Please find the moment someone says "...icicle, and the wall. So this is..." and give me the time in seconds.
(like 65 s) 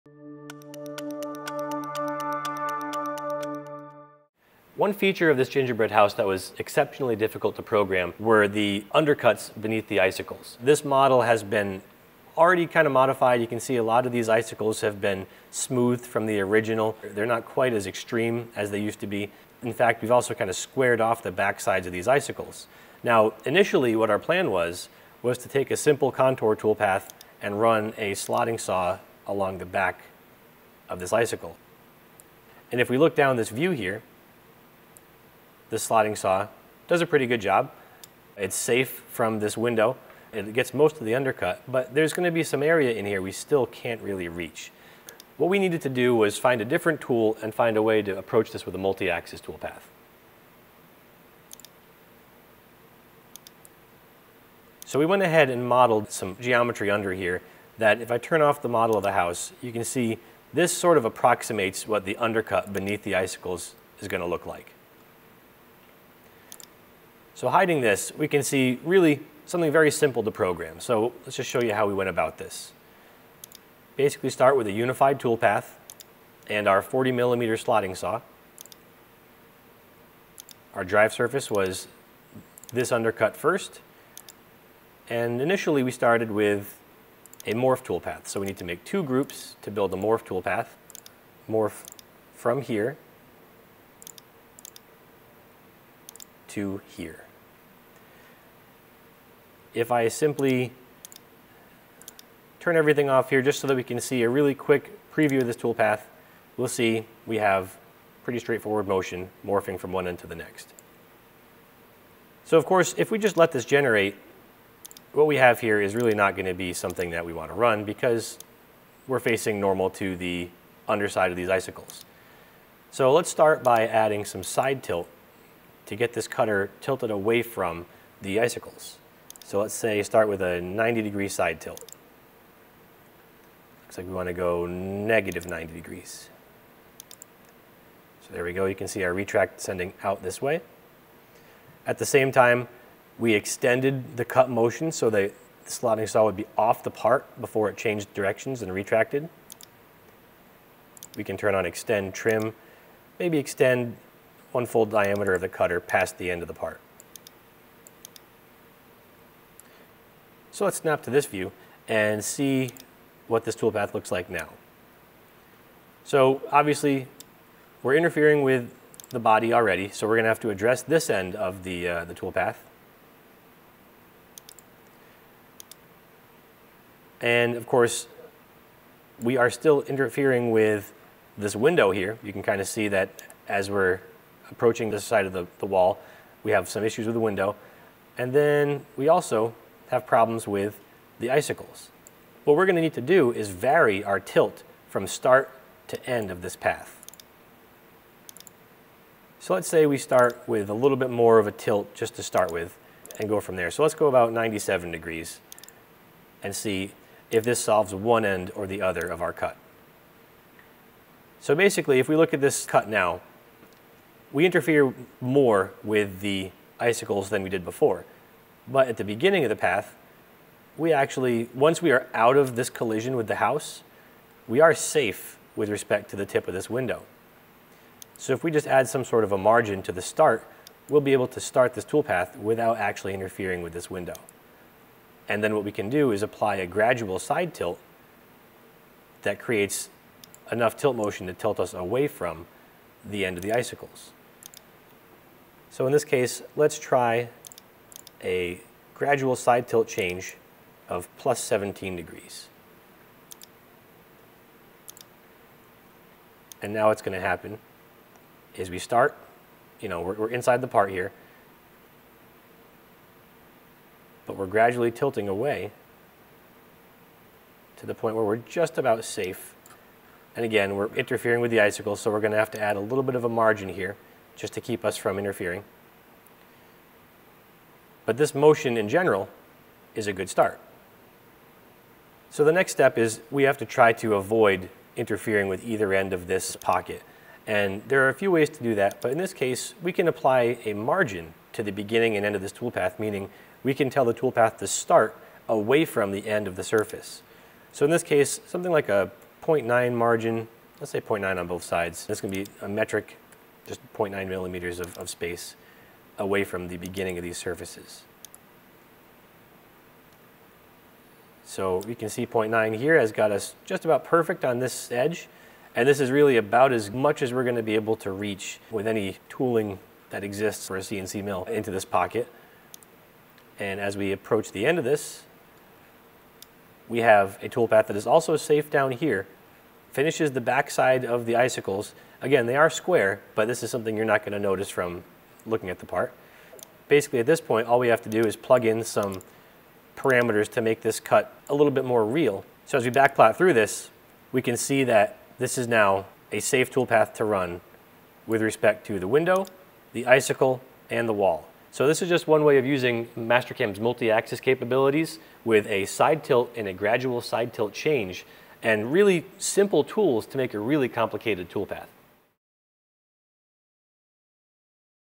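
350 s.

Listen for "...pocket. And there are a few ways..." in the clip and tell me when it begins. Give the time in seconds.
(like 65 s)
286 s.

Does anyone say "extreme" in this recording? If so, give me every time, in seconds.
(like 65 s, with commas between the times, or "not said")
17 s.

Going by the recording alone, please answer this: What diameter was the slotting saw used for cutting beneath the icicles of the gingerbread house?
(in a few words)
40 millimeters.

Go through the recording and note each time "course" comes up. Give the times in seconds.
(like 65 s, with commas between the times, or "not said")
112 s, 177 s.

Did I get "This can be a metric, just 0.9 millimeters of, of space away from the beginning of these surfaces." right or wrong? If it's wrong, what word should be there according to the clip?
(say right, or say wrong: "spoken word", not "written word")
right.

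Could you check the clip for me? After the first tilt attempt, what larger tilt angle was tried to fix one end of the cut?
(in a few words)
97 degrees.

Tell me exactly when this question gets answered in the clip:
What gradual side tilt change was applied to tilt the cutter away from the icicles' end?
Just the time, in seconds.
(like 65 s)
251 s.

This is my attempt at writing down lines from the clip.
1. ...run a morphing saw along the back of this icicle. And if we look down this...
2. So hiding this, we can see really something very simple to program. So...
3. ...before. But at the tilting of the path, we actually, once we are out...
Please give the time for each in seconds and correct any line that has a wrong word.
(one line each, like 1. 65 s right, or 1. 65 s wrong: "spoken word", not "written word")
1. 27 s wrong: "slotting", not "morphing"
2. 67 s right
3. 217 s wrong: "beginning", not "tilting".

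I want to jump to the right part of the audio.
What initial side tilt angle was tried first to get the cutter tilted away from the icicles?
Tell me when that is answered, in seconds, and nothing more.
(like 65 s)
130 s.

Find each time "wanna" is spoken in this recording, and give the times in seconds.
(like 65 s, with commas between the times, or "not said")
117 s.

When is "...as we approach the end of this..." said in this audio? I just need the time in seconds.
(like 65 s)
323 s.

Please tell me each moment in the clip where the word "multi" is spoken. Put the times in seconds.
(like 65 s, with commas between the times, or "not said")
48 s, 353 s.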